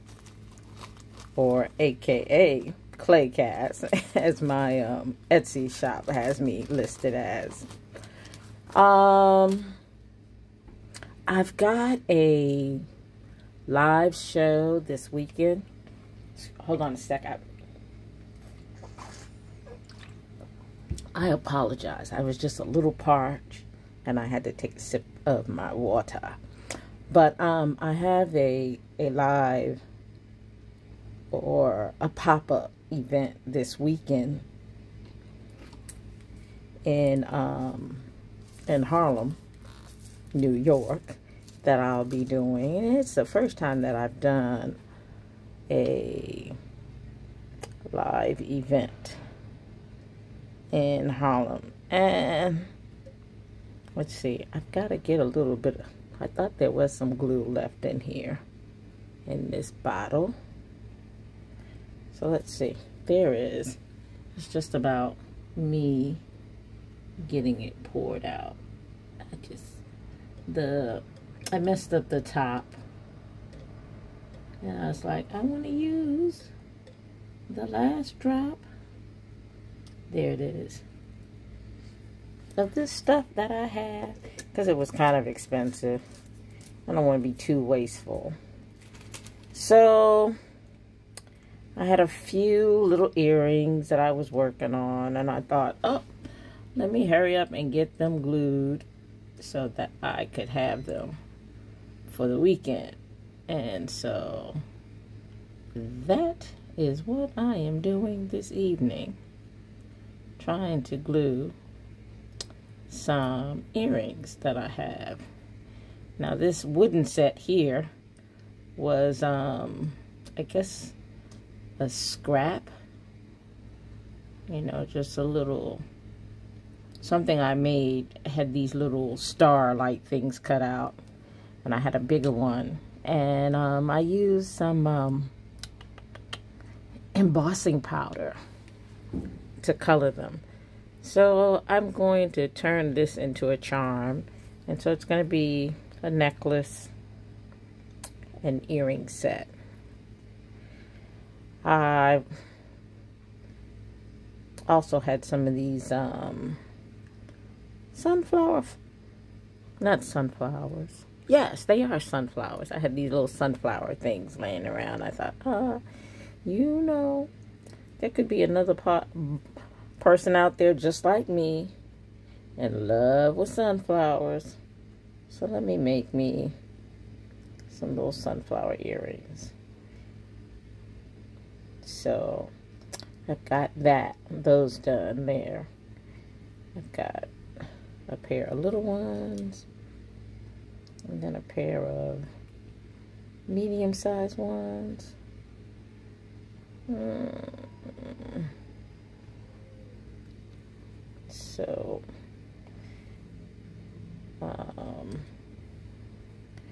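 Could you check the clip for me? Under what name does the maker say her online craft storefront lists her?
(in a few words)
Clay Cass.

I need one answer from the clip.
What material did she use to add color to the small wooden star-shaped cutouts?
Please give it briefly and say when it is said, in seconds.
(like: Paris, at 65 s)
embossing powder, at 137 s.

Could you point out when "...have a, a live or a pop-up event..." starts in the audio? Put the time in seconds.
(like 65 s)
27 s.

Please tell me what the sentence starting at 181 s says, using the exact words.
So I've got that, those done there.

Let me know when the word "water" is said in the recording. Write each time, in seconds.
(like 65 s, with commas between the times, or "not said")
25 s.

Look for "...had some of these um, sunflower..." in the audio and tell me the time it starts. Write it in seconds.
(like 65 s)
155 s.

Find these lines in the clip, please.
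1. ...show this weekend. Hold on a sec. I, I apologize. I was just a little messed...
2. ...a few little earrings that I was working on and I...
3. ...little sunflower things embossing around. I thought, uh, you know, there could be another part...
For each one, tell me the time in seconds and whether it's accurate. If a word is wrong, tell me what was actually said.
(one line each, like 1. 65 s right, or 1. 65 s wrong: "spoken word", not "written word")
1. 14 s wrong: "parched", not "messed"
2. 92 s right
3. 163 s wrong: "laying", not "embossing".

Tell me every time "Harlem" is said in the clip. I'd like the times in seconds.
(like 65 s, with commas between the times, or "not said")
38 s, 51 s.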